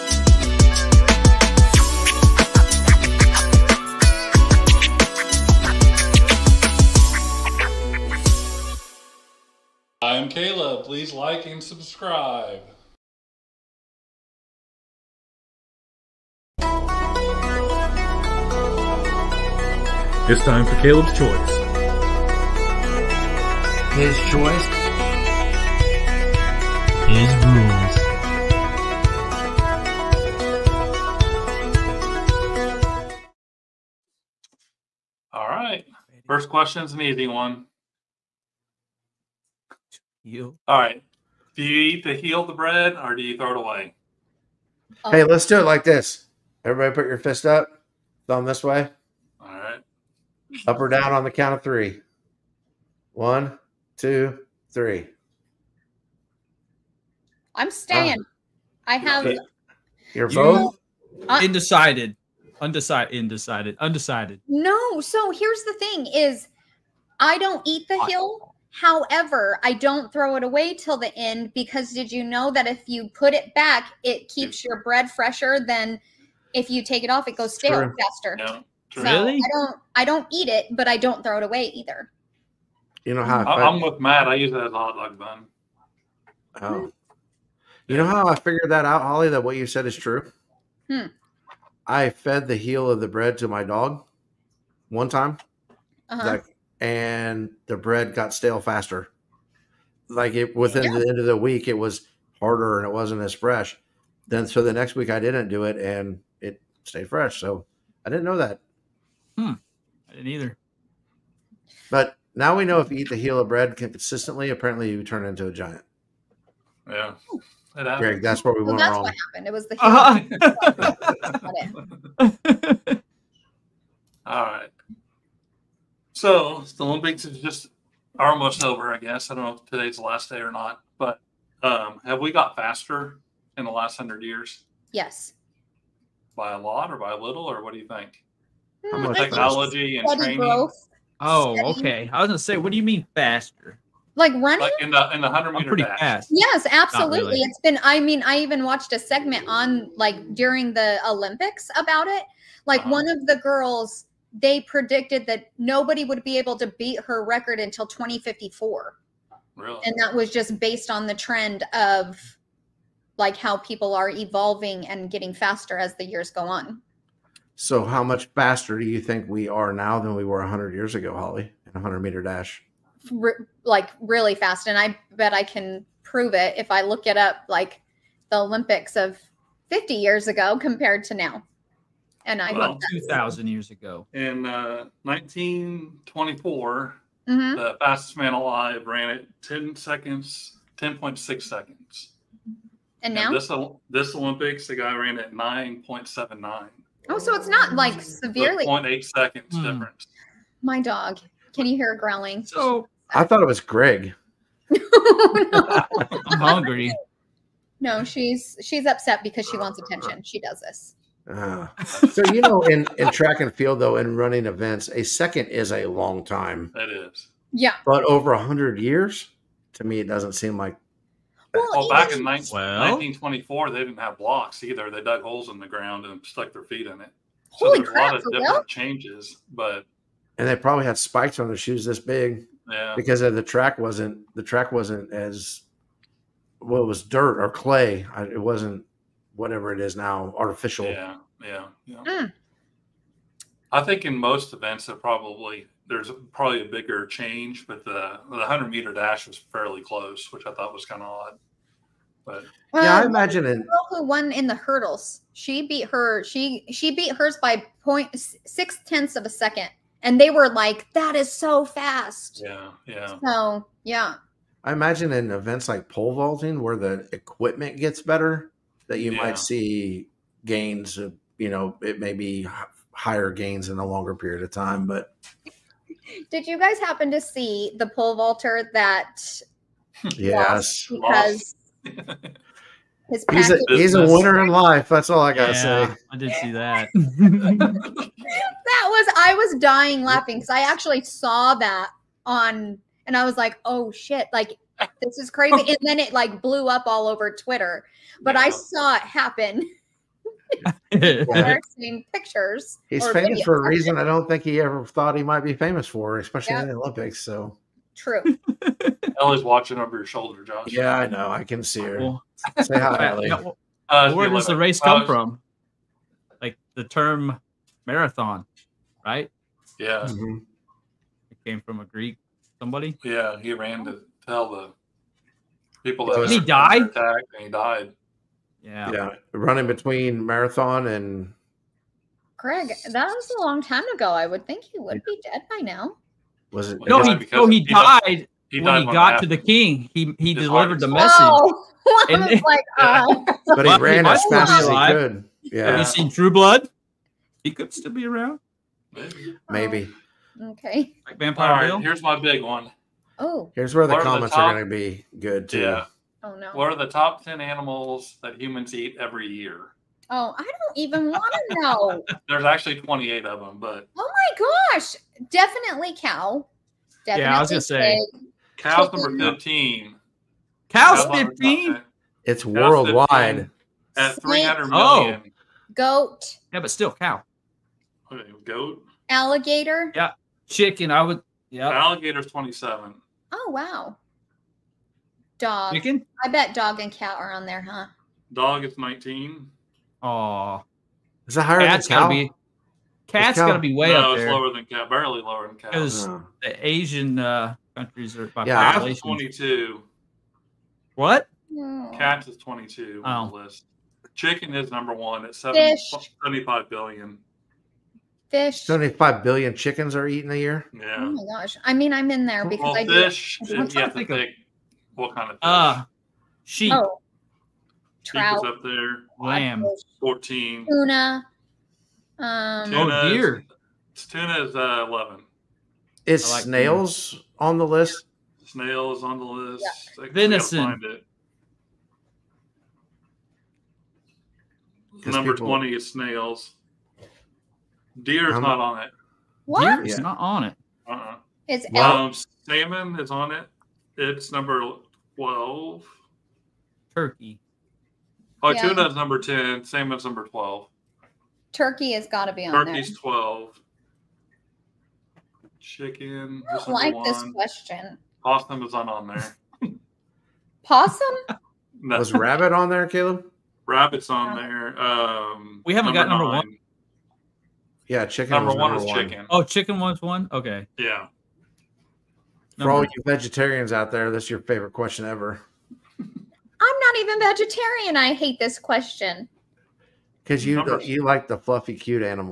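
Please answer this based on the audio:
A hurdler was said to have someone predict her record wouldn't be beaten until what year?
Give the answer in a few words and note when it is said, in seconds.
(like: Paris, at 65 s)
2054, at 157 s.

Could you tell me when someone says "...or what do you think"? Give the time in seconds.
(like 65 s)
137 s.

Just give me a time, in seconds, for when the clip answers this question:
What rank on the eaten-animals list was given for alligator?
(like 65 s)
382 s.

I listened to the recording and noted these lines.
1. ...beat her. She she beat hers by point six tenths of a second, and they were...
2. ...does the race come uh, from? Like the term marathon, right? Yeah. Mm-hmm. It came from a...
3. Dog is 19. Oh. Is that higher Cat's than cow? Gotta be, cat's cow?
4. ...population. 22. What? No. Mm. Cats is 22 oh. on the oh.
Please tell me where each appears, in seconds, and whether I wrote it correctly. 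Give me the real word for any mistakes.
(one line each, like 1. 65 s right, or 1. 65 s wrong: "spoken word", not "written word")
1. 255 s right
2. 314 s right
3. 388 s right
4. 398 s right.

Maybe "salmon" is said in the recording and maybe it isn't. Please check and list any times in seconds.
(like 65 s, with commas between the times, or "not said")
442 s, 449 s.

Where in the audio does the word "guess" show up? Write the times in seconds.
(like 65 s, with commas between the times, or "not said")
128 s.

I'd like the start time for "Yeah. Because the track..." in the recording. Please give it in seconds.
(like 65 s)
232 s.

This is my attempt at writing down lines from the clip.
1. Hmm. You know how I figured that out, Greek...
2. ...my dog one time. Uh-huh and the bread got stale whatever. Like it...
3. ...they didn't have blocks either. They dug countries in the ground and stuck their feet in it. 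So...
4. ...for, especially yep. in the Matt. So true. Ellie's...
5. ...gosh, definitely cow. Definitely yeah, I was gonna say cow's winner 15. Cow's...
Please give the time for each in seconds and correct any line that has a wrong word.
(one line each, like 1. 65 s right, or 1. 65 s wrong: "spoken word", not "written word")
1. 86 s wrong: "Holly", not "Greek"
2. 93 s wrong: "faster", not "whatever"
3. 223 s wrong: "holes", not "countries"
4. 305 s wrong: "Olympics", not "Matt"
5. 364 s wrong: "number", not "winner".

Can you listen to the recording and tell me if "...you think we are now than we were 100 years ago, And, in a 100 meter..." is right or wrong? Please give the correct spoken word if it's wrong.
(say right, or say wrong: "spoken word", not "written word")
wrong: "Holly", not "And".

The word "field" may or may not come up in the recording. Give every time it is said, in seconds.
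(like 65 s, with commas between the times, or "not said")
213 s.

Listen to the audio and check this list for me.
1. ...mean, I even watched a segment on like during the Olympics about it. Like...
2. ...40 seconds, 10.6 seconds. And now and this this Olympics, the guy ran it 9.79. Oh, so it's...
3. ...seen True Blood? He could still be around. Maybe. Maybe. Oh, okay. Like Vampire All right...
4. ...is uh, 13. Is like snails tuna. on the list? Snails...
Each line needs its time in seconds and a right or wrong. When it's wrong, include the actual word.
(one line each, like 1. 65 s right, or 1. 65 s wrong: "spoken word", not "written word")
1. 147 s right
2. 189 s wrong: "10", not "40"
3. 345 s right
4. 424 s wrong: "11", not "13".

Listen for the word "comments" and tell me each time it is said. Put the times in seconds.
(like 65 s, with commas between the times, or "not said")
354 s.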